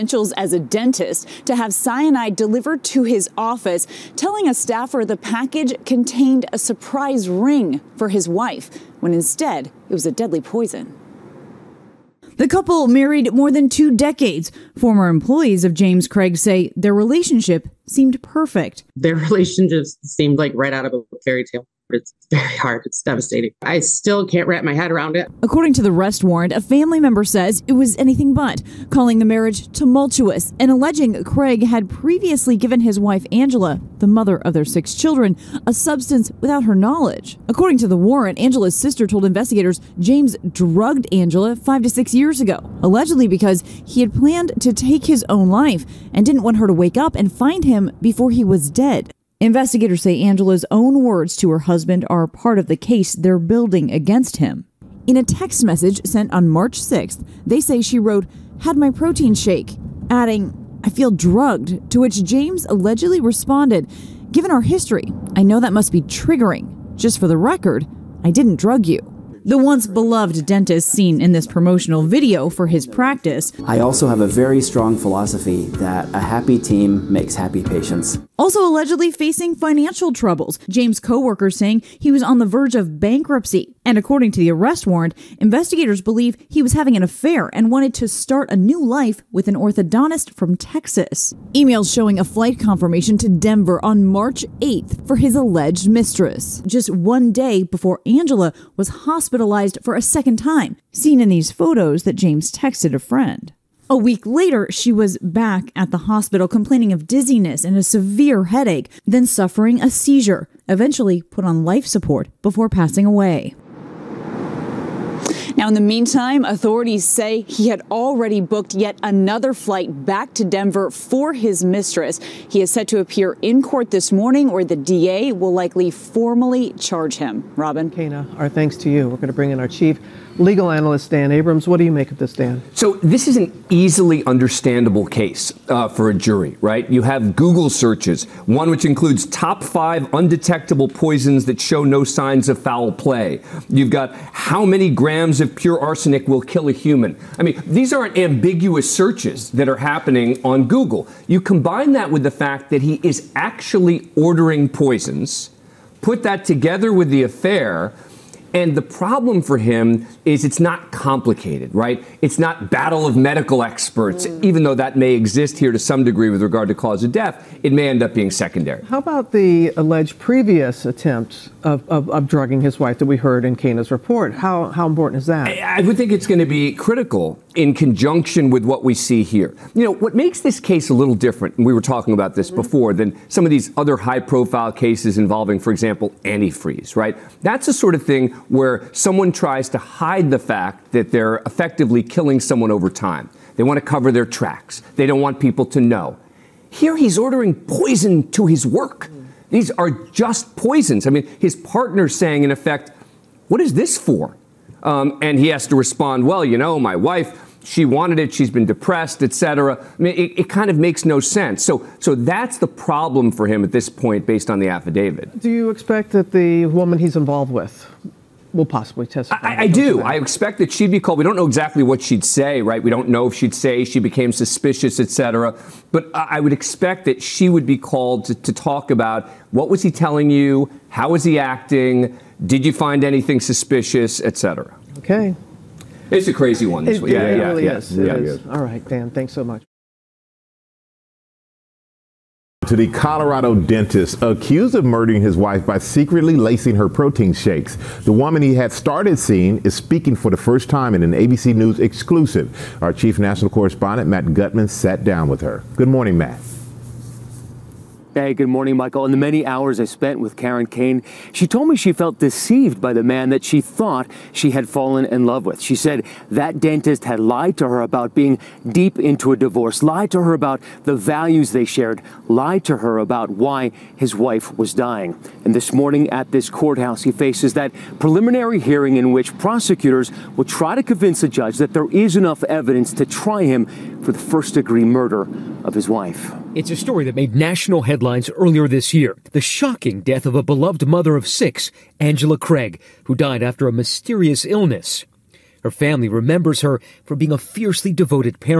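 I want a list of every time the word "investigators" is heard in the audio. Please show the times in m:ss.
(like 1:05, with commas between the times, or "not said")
0:39, 0:49, 1:25.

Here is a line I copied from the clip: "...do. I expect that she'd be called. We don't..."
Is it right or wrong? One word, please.
right.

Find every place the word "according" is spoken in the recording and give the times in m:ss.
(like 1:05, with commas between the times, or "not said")
0:25, 0:37, 1:23.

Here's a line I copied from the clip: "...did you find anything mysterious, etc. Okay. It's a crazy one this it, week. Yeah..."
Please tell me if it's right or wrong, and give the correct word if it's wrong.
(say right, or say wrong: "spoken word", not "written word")
wrong: "suspicious", not "mysterious".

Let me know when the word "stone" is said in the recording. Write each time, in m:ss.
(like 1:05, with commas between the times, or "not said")
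not said.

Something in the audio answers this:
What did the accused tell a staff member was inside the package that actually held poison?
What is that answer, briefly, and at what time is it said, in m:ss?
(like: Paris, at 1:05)
a surprise ring for his wife, at 0:06.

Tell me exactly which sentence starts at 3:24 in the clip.
Um, and he has to respond, well, you know, my wife she wanted it, she's been depressed, etc.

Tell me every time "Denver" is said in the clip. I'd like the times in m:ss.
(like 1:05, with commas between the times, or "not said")
1:33, 2:00.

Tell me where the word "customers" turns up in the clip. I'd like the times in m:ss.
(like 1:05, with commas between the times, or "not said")
not said.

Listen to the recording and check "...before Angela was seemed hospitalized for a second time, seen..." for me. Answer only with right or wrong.
wrong.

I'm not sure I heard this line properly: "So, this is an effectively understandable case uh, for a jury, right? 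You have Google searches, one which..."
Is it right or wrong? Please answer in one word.
wrong.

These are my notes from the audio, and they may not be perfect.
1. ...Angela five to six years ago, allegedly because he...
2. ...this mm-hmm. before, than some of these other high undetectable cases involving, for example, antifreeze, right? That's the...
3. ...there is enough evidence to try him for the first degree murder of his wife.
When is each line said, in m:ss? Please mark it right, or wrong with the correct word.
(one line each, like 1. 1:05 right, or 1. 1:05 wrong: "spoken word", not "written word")
1. 0:41 right
2. 3:02 wrong: "profile", not "undetectable"
3. 4:41 right.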